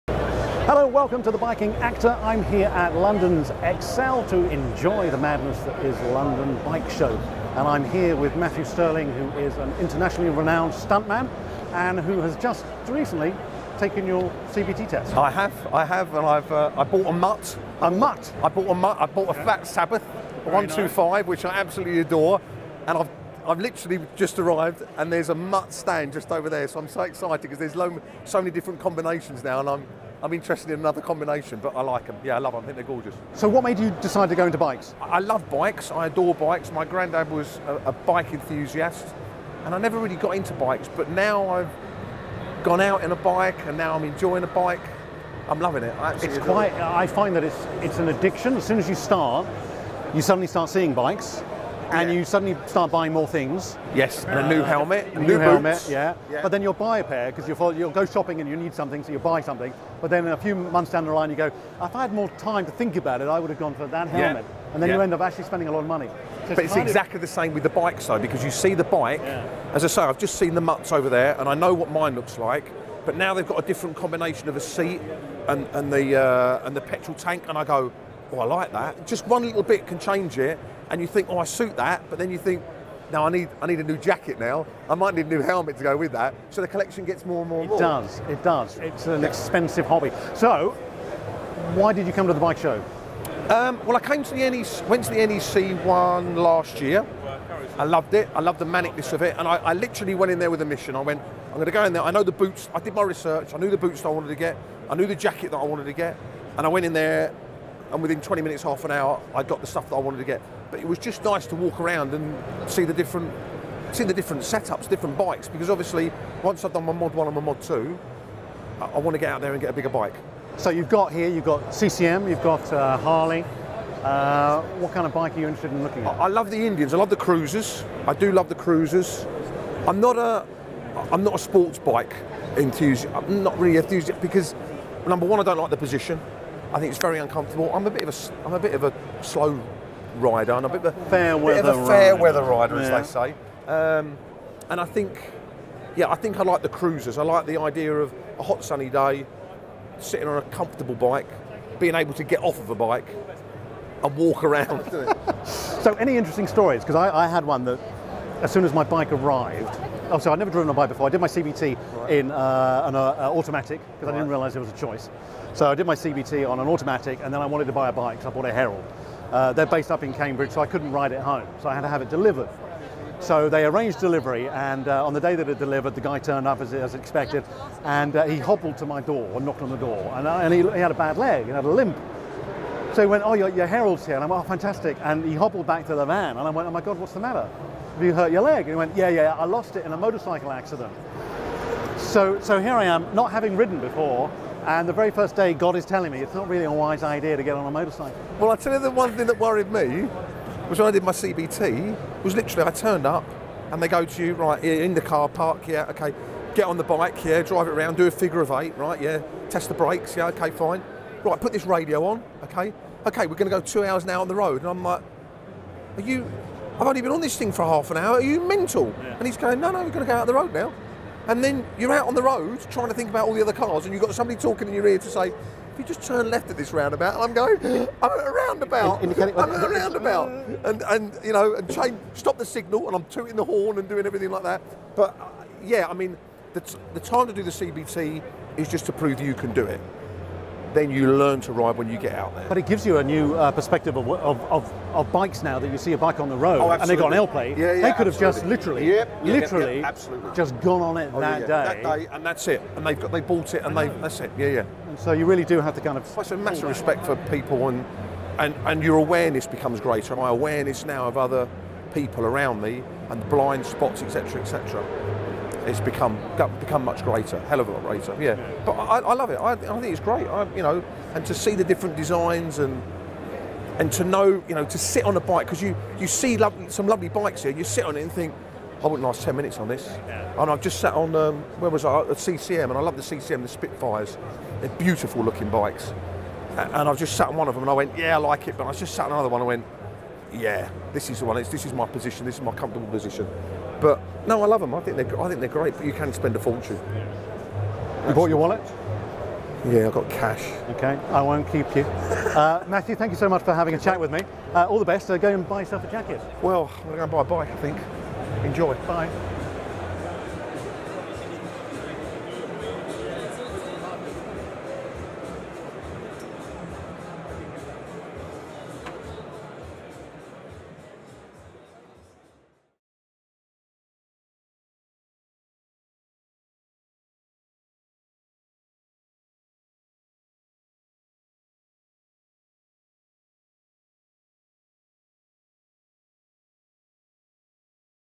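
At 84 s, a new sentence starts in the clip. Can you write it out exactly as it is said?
I might need a new helmet to go with that.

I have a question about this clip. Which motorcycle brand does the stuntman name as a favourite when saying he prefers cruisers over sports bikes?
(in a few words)
Indians.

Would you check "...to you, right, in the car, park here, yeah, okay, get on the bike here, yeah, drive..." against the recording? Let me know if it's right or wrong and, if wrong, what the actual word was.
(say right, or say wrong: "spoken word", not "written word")
right.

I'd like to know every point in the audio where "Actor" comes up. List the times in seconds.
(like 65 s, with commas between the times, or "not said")
1 s.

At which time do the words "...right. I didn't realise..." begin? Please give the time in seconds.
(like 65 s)
164 s.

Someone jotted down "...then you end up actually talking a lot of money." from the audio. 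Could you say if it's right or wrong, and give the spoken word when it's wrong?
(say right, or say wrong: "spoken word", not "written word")
wrong: "spending", not "talking".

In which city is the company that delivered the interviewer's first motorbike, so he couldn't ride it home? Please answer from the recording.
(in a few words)
Cambridge.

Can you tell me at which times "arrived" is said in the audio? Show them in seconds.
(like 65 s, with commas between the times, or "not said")
24 s, 159 s.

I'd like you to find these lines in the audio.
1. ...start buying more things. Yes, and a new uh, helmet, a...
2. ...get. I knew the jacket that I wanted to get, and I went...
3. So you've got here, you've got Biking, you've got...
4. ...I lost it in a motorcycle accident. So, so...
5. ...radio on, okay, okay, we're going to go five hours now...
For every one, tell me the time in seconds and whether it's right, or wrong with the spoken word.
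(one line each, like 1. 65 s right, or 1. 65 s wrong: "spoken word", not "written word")
1. 52 s right
2. 104 s right
3. 120 s wrong: "CCM", not "Biking"
4. 189 s right
5. 211 s wrong: "two", not "five".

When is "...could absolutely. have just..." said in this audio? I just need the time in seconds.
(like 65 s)
247 s.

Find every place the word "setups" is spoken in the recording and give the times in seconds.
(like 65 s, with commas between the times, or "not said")
114 s.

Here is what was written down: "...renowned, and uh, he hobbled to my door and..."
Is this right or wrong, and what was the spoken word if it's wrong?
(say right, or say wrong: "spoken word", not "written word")
wrong: "expected", not "renowned".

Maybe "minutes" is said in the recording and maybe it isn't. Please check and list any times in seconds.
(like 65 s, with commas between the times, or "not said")
108 s, 279 s.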